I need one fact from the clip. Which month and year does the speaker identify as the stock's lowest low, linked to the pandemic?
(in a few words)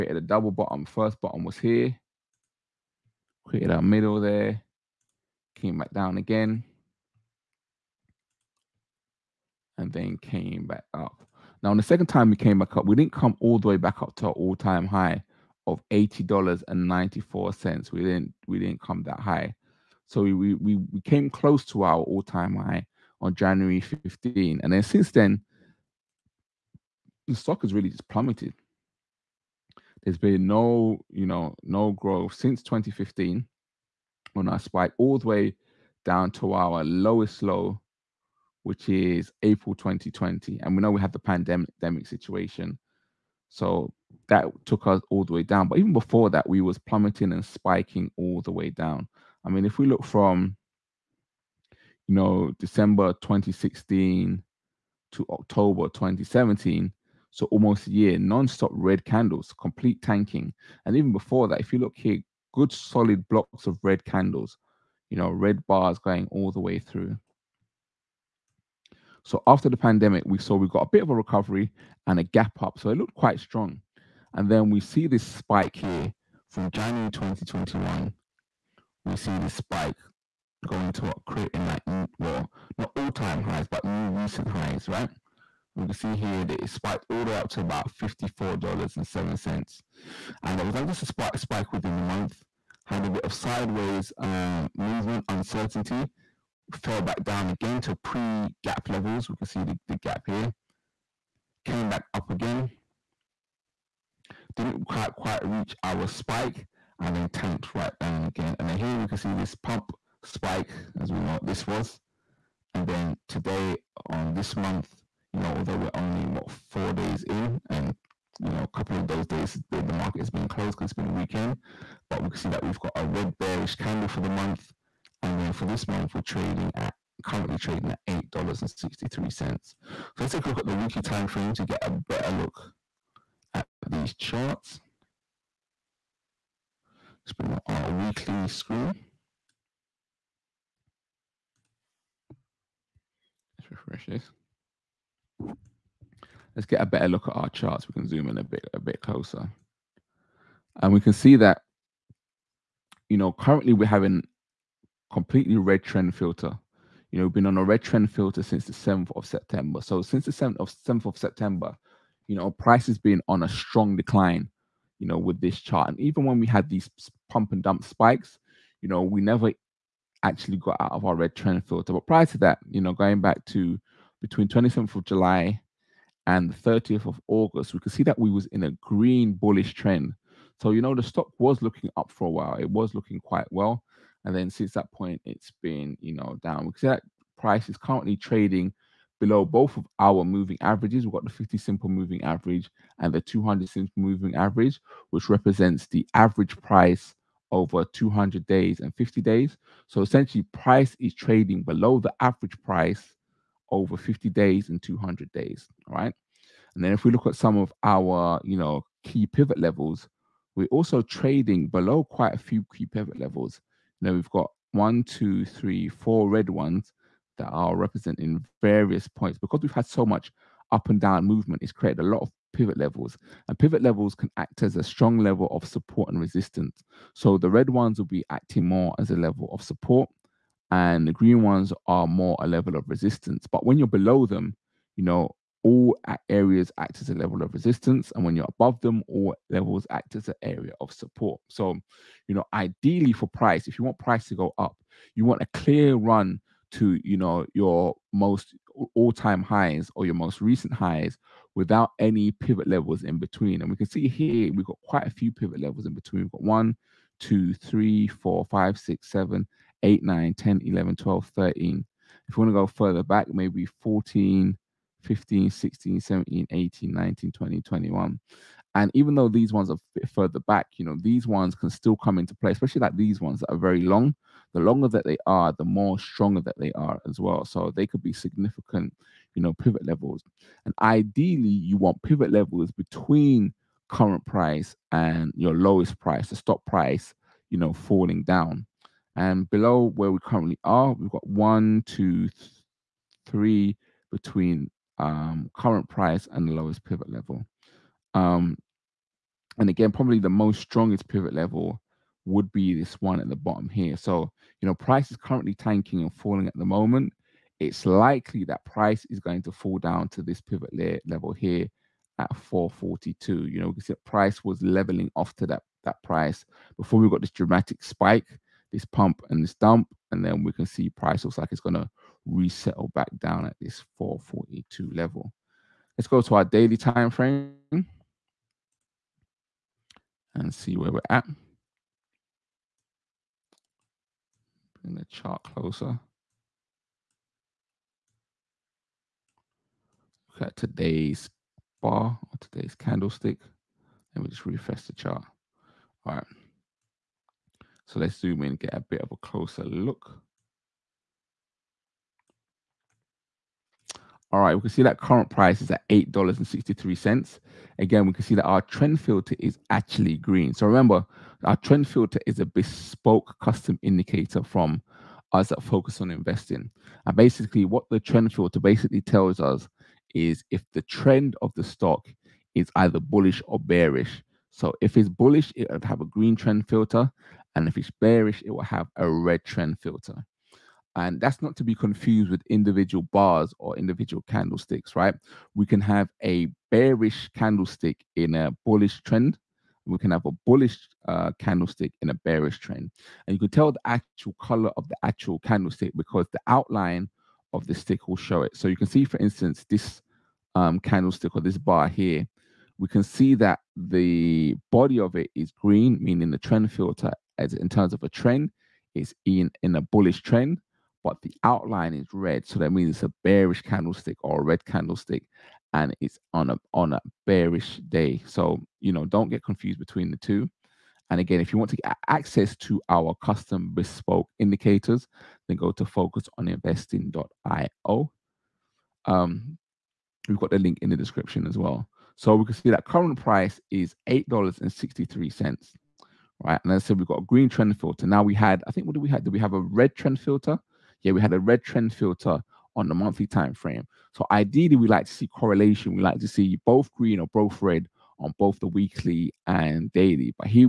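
April 2020.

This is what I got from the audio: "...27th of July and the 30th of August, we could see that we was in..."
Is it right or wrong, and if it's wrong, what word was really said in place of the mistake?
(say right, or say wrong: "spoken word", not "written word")
right.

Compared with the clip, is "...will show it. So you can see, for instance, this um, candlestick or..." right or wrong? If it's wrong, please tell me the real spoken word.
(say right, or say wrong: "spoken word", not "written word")
right.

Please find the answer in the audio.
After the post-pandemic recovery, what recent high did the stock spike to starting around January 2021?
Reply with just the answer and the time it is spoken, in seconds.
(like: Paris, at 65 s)
$54.07, at 88 s.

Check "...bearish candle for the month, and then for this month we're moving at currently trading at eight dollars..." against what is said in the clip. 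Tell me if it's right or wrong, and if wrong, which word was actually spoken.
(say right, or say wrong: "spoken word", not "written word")
wrong: "trading", not "moving".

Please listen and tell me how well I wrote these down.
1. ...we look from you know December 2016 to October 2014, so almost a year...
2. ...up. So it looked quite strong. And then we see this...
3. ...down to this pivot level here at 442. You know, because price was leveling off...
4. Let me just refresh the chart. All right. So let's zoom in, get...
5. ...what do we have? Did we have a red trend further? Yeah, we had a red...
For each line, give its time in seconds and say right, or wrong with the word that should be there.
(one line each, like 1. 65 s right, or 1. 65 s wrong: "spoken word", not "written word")
1. 49 s wrong: "2017", not "2014"
2. 72 s right
3. 309 s right
4. 344 s right
5. 438 s wrong: "filter", not "further".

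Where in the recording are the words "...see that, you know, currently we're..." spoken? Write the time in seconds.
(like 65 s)
151 s.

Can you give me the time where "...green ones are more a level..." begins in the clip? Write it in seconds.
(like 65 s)
231 s.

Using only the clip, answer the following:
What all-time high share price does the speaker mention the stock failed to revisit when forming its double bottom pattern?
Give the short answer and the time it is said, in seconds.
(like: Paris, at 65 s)
$80.94, at 15 s.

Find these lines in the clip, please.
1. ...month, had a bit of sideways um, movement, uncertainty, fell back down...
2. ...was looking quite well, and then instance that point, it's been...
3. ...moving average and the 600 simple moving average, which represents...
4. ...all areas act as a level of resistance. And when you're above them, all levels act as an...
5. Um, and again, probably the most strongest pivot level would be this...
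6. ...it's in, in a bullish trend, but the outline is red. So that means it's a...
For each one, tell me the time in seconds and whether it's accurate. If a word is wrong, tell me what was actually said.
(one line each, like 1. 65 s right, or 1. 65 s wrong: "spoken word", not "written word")
1. 92 s right
2. 182 s wrong: "since", not "instance"
3. 191 s wrong: "200", not "600"
4. 235 s right
5. 298 s right
6. 408 s right.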